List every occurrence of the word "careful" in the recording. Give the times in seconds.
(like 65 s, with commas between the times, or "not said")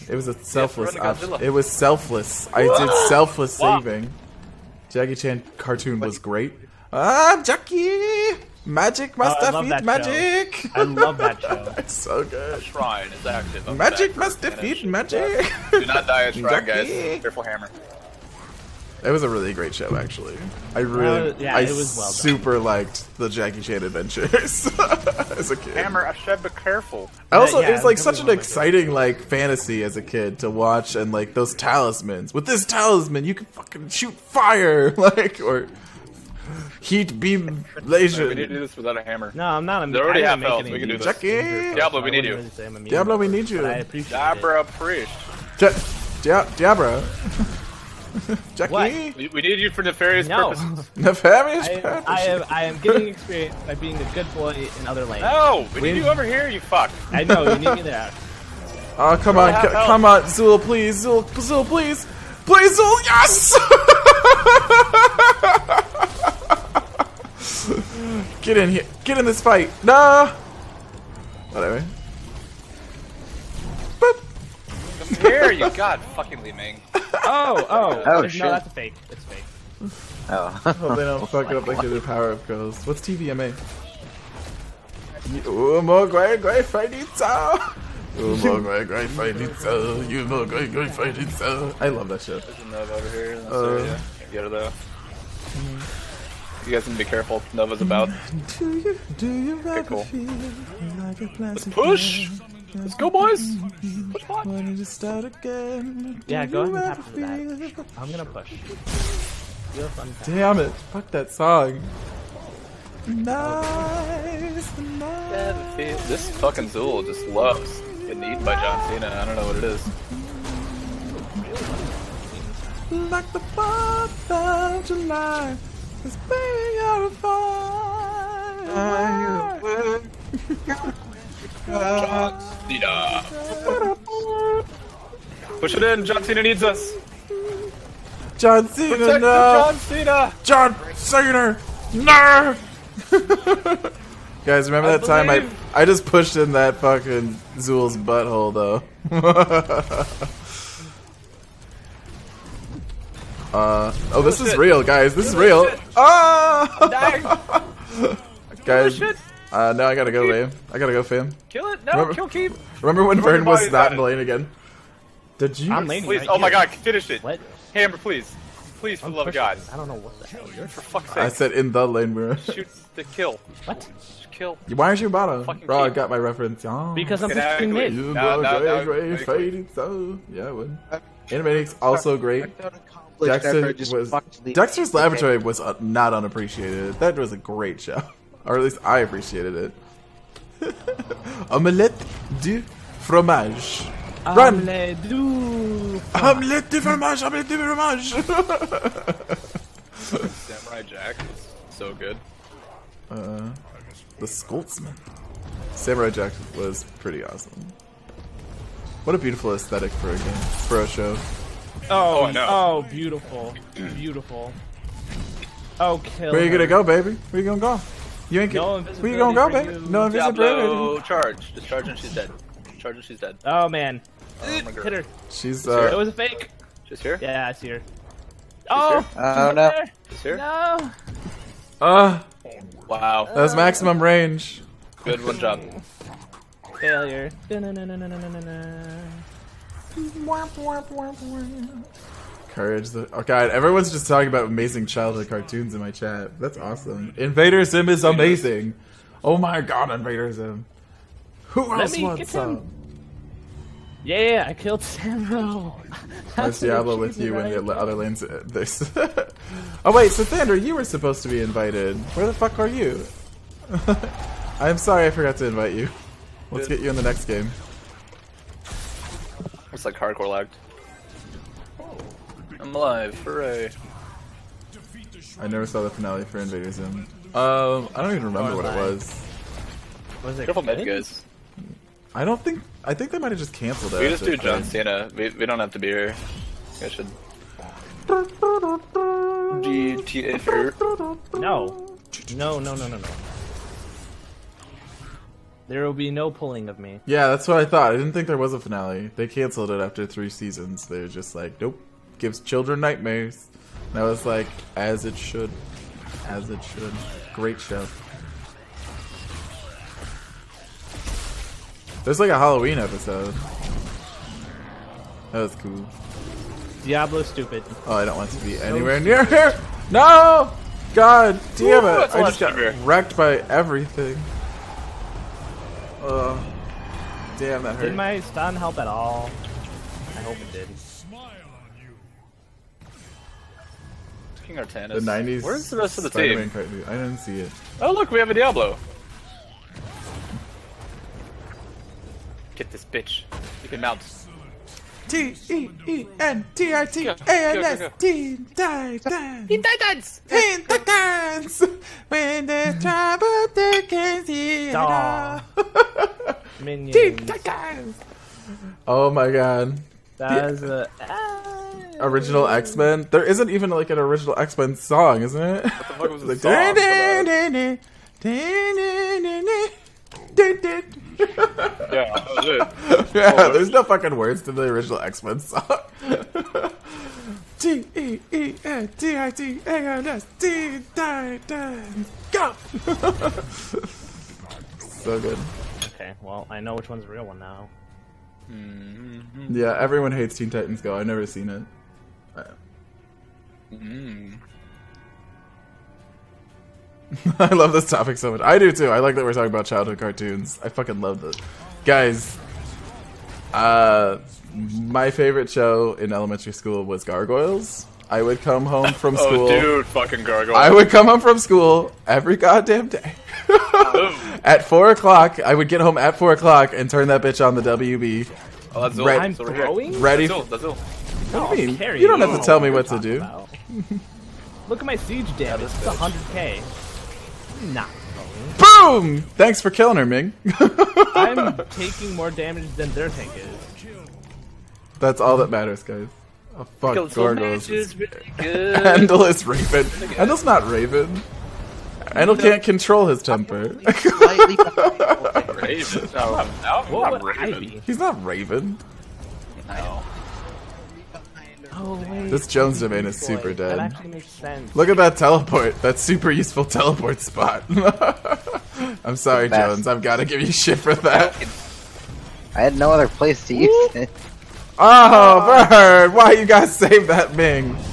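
26 s, 97 s, 280 s.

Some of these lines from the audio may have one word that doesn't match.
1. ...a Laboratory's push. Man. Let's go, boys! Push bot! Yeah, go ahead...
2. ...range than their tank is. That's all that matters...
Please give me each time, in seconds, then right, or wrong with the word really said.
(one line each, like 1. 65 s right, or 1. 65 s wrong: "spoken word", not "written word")
1. 101 s wrong: "Let", not "Laboratory"
2. 432 s wrong: "damage", not "range".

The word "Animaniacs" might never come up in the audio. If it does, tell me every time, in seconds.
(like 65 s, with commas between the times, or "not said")
181 s.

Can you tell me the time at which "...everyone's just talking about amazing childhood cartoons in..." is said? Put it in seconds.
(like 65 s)
243 s.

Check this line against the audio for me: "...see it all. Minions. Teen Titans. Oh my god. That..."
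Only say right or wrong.
right.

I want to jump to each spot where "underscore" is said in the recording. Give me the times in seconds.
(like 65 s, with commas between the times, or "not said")
not said.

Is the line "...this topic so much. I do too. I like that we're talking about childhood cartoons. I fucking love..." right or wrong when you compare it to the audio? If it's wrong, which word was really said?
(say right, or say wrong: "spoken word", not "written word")
right.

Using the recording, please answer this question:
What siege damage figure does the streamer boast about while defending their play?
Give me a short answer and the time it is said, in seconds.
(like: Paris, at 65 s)
100k, at 425 s.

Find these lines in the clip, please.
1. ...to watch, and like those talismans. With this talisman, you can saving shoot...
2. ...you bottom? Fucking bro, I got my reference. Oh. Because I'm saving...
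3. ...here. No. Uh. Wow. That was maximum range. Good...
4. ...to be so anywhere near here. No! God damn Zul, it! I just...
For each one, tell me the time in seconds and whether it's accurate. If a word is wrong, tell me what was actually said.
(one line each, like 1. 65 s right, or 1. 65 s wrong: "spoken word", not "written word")
1. 30 s wrong: "fucking", not "saving"
2. 174 s wrong: "pushing", not "saving"
3. 230 s right
4. 318 s wrong: "Ooh", not "Zul".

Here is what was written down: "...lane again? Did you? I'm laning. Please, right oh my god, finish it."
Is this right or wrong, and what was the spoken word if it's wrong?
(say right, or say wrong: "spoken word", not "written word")
right.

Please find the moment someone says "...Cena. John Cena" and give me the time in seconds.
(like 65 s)
139 s.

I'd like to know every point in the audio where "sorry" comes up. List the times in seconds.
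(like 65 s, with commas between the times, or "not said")
264 s, 459 s.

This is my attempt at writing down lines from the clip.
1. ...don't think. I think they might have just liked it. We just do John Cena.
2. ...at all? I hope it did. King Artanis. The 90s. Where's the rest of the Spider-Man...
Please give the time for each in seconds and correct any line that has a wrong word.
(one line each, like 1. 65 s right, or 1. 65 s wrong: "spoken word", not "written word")
1. 282 s wrong: "canceled", not "liked"
2. 328 s right.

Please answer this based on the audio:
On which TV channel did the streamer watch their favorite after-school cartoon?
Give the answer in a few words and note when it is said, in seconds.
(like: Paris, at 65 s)
The WB, at 417 s.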